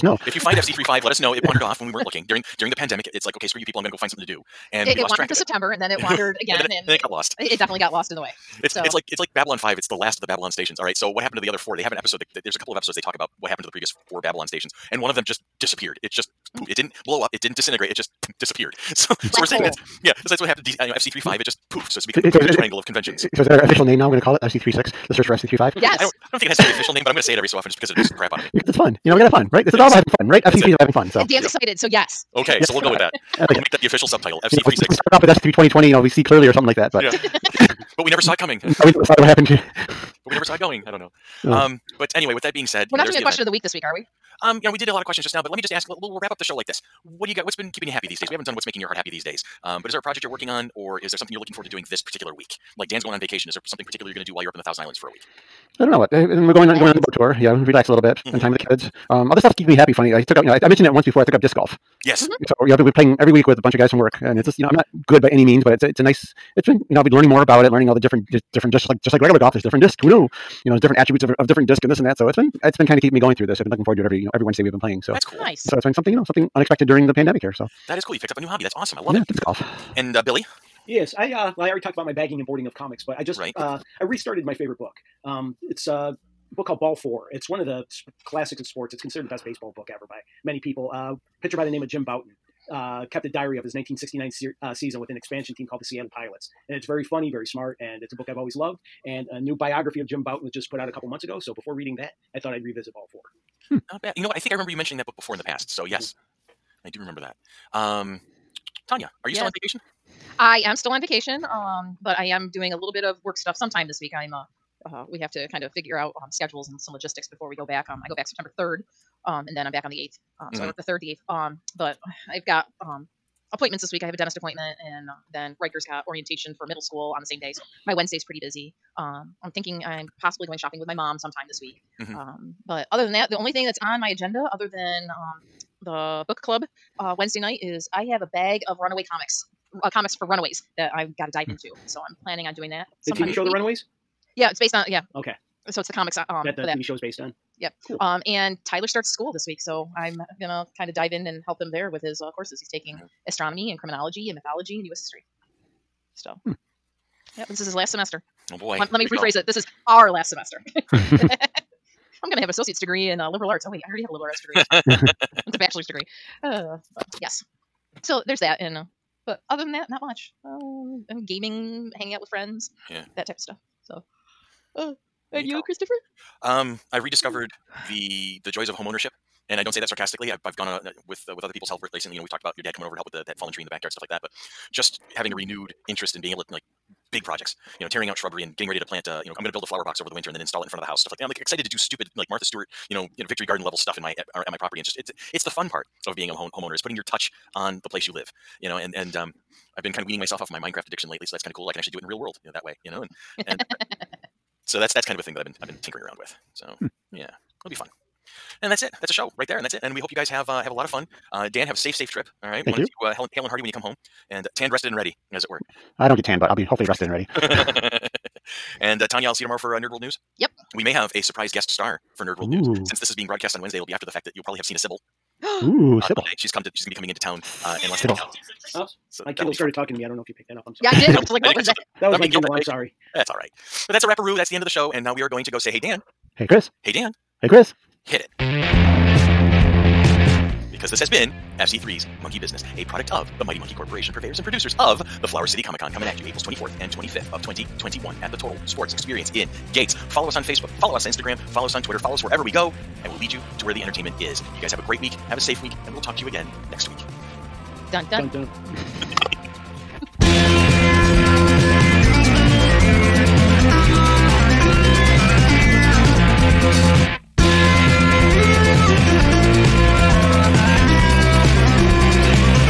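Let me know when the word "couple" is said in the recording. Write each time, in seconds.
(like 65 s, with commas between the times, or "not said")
12 s, 100 s.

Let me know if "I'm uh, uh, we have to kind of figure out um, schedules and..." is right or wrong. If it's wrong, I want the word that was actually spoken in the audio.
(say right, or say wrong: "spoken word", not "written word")
right.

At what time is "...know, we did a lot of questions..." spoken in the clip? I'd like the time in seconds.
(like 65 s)
44 s.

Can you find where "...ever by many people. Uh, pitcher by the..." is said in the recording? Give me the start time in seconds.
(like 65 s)
89 s.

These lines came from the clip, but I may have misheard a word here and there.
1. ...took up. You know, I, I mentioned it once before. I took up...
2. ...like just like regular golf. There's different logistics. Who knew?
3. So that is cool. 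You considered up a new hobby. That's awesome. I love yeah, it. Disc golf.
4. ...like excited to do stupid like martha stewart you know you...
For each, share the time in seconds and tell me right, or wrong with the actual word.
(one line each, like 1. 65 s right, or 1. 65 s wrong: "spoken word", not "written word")
1. 60 s right
2. 68 s wrong: "discs", not "logistics"
3. 77 s wrong: "picked", not "considered"
4. 191 s right.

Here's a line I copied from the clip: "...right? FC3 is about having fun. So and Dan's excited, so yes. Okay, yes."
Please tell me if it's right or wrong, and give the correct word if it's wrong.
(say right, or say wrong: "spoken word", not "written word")
right.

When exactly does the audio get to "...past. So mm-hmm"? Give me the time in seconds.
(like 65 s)
105 s.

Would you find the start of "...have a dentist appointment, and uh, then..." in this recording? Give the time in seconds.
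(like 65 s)
124 s.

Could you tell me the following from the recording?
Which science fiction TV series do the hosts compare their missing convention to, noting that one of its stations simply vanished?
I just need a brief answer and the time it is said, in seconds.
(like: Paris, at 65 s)
Babylon Five, at 9 s.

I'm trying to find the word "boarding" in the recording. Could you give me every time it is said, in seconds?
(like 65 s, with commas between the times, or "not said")
82 s.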